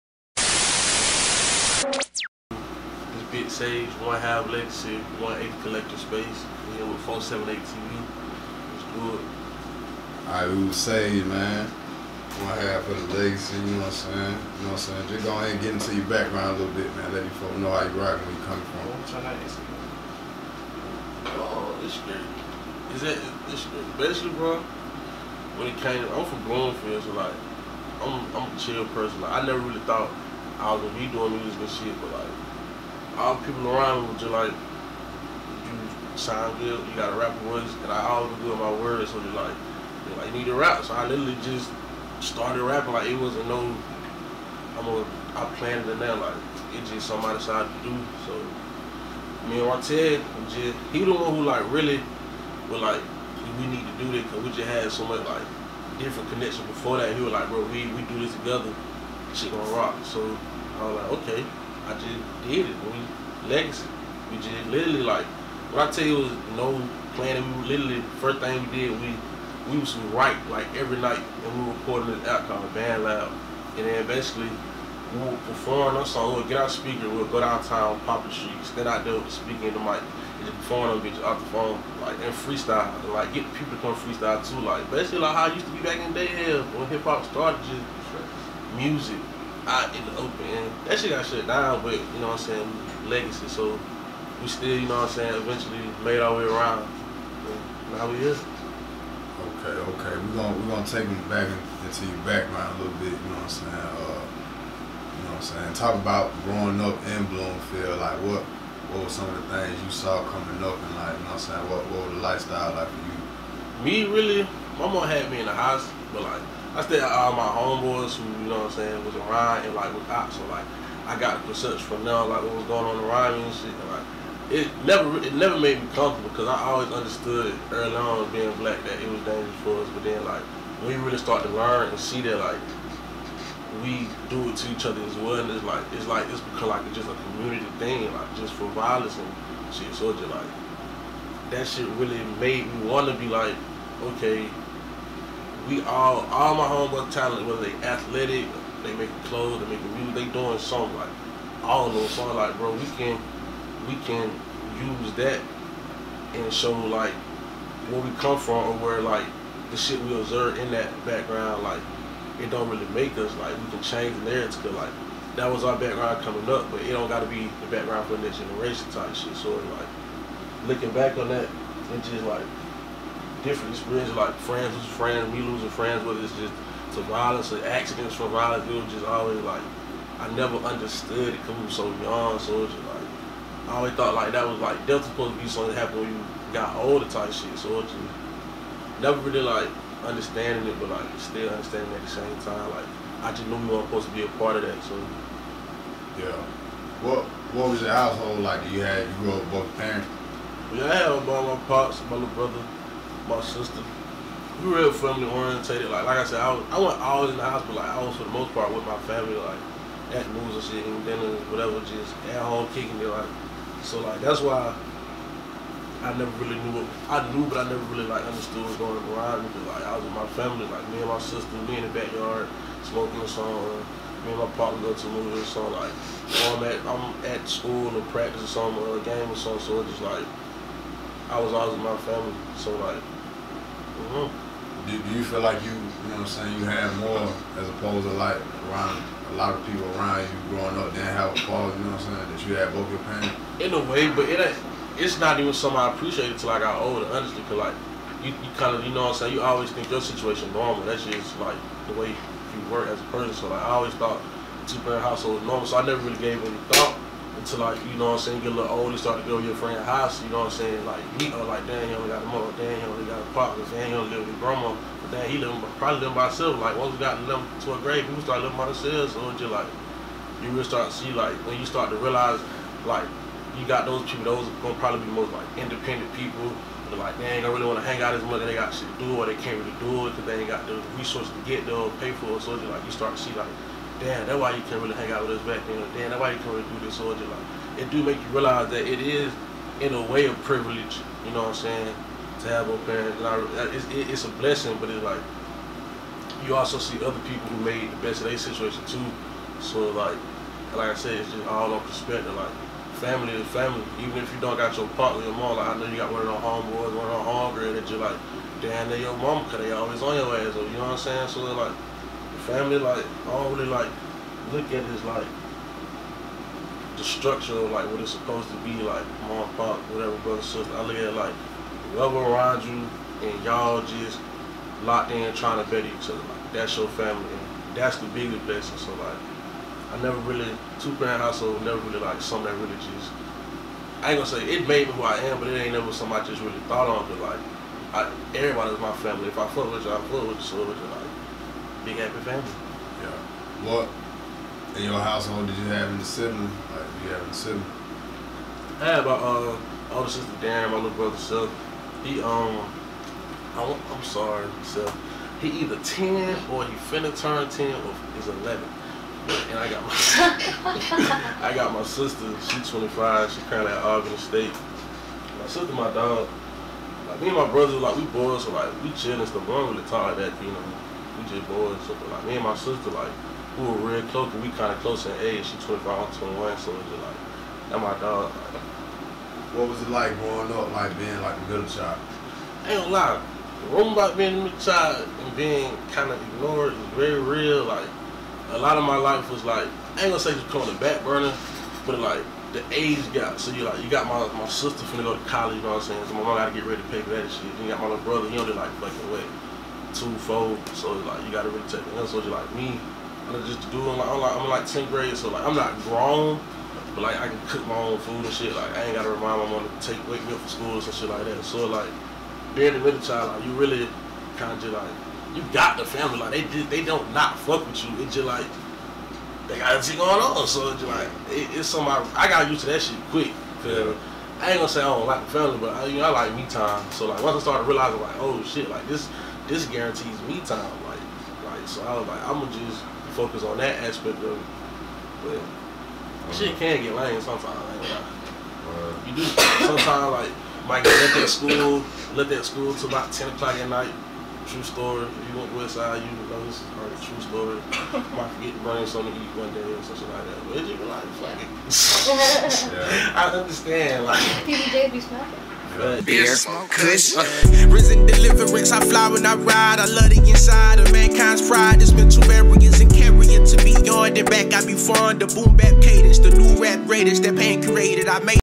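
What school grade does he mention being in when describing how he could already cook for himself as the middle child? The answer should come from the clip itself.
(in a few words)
10th grade.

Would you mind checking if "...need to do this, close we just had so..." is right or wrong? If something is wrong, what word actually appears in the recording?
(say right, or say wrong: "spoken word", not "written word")
wrong: "cause", not "close".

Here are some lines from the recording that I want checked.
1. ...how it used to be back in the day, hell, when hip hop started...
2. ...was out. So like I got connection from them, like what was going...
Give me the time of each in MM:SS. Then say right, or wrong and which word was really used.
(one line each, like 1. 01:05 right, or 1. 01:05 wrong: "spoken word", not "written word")
1. 01:25 right
2. 01:59 wrong: "perception", not "connection".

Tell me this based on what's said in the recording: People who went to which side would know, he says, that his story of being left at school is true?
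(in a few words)
West side.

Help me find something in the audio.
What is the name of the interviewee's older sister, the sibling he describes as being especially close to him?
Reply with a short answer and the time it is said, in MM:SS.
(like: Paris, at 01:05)
Darren, at 05:50.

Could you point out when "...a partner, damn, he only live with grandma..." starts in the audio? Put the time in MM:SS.
04:23.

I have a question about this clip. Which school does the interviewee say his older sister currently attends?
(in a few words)
Auburn State.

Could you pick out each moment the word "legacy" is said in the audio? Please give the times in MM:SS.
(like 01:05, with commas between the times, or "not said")
00:13, 01:03, 01:33.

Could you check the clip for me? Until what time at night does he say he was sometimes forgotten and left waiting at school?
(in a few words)
10 o'clock.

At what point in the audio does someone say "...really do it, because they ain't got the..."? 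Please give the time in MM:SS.
04:39.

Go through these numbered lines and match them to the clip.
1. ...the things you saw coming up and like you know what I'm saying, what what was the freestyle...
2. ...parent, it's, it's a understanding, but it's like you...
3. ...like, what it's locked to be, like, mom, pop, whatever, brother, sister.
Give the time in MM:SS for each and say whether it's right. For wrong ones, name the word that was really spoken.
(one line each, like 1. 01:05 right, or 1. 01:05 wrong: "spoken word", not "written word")
1. 01:49 wrong: "lifestyle", not "freestyle"
2. 04:52 wrong: "blessing", not "understanding"
3. 05:17 wrong: "supposed", not "locked".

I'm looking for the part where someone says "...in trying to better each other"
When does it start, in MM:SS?
05:25.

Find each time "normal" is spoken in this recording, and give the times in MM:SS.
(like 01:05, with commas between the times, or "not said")
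04:10, 04:15.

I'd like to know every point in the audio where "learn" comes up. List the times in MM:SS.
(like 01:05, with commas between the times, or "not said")
02:11.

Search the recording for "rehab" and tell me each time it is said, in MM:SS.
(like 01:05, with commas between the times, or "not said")
not said.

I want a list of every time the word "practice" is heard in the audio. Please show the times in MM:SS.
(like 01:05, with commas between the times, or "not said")
03:48.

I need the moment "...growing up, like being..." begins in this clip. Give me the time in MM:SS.
06:20.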